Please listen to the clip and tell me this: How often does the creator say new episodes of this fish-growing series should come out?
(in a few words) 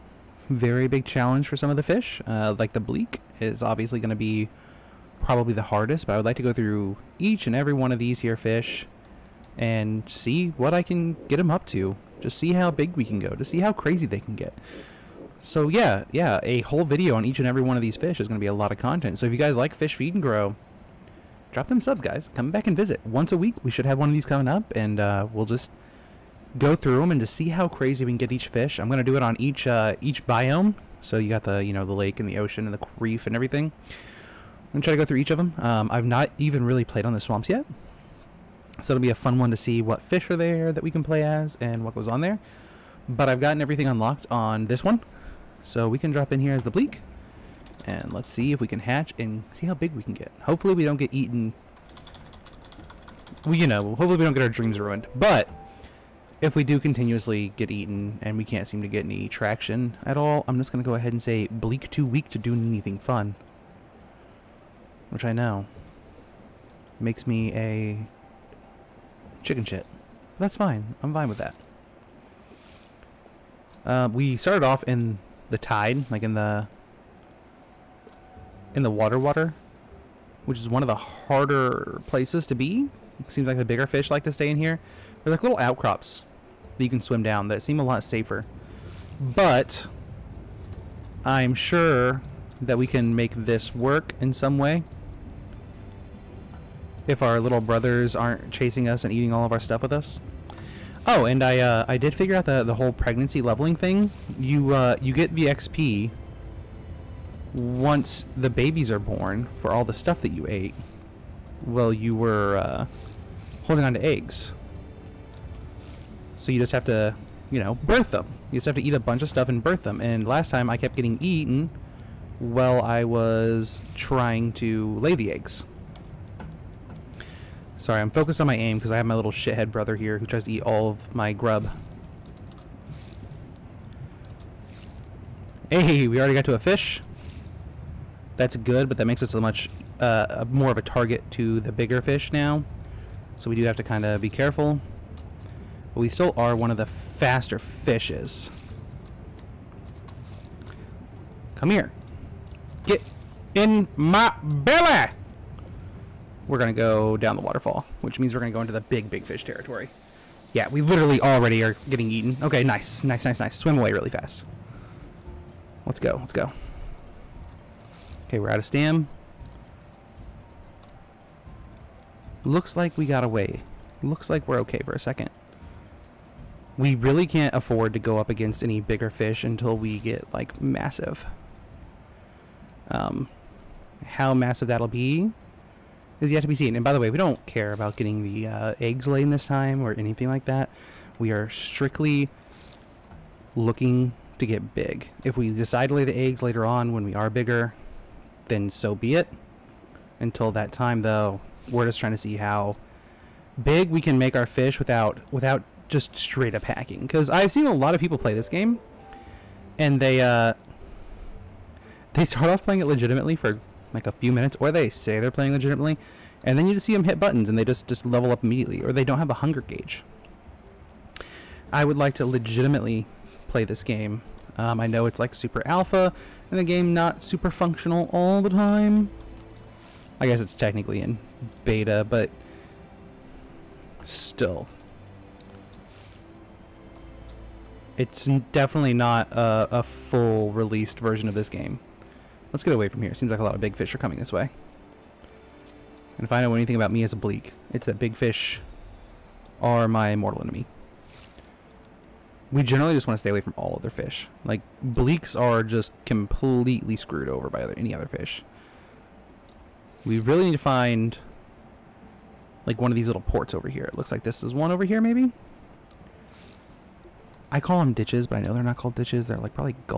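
Once a week.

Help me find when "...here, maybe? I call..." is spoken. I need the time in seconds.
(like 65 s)
264 s.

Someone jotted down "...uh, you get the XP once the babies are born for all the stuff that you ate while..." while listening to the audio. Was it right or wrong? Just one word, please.
right.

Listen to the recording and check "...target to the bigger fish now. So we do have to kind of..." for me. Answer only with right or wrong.
right.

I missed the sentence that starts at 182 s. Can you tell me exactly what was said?
Um, how massive that'll be is yet to be seen.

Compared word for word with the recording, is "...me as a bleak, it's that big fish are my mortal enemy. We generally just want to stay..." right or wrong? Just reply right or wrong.
right.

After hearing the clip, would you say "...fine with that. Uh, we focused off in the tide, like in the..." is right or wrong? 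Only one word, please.
wrong.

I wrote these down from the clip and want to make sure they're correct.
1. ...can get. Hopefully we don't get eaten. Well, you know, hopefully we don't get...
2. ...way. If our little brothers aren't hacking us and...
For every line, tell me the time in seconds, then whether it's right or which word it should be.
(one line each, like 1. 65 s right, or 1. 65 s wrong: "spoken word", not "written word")
1. 50 s right
2. 94 s wrong: "chasing", not "hacking".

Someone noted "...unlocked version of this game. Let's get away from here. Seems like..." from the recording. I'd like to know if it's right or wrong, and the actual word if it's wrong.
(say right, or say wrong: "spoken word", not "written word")
wrong: "released", not "unlocked".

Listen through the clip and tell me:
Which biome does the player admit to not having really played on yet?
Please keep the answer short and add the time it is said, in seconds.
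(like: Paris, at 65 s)
The swamps, at 37 s.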